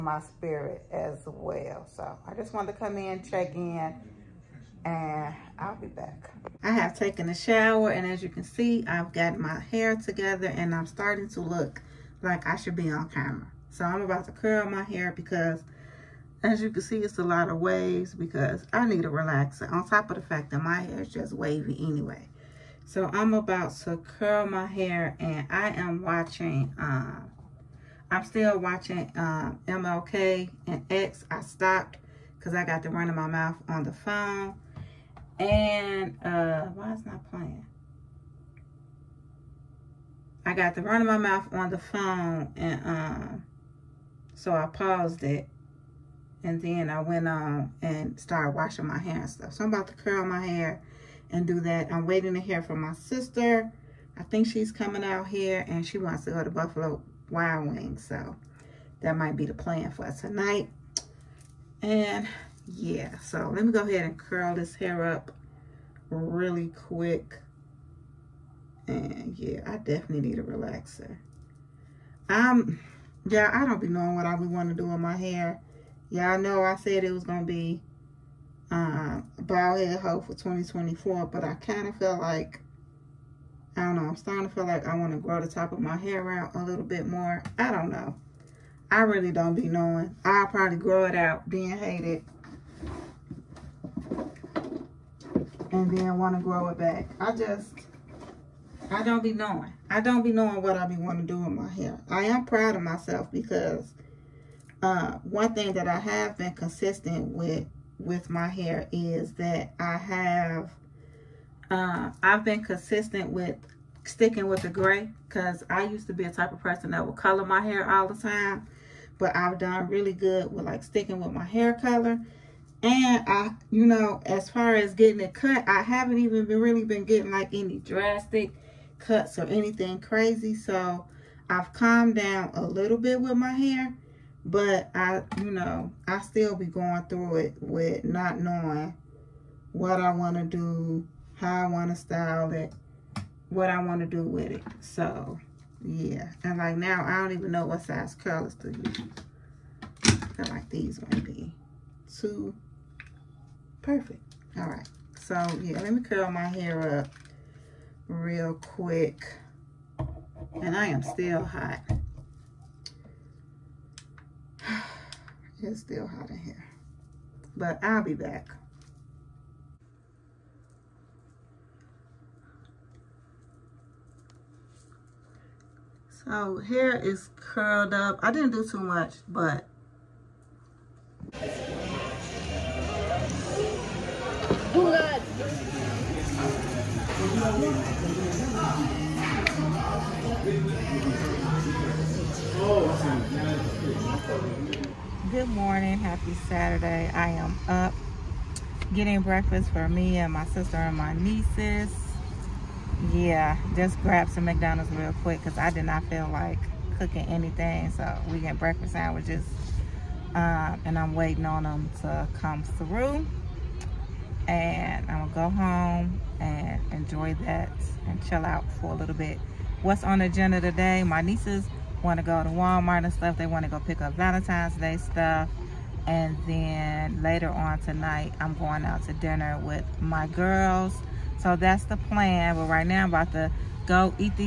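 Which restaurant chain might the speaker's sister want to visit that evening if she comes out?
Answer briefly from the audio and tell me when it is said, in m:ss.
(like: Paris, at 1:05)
Buffalo Wild Wings, at 0:56.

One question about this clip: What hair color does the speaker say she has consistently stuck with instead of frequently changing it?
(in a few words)
Gray.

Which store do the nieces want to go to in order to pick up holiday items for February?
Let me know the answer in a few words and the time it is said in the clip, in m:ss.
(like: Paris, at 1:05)
Walmart, at 3:42.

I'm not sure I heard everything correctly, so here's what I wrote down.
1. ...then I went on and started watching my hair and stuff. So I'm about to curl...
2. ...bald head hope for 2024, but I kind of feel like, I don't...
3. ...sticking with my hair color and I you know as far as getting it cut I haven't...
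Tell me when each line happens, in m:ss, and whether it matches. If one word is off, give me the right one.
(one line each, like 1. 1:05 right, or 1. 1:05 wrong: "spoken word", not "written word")
1. 0:46 wrong: "washing", not "watching"
2. 1:19 right
3. 2:00 right.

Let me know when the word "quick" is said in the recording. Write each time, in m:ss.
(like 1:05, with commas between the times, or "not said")
1:06, 2:38, 3:25.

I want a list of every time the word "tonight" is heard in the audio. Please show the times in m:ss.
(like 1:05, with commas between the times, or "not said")
1:00, 3:47.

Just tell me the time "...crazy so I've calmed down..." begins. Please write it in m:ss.
2:09.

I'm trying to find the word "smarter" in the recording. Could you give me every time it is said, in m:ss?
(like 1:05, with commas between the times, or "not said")
not said.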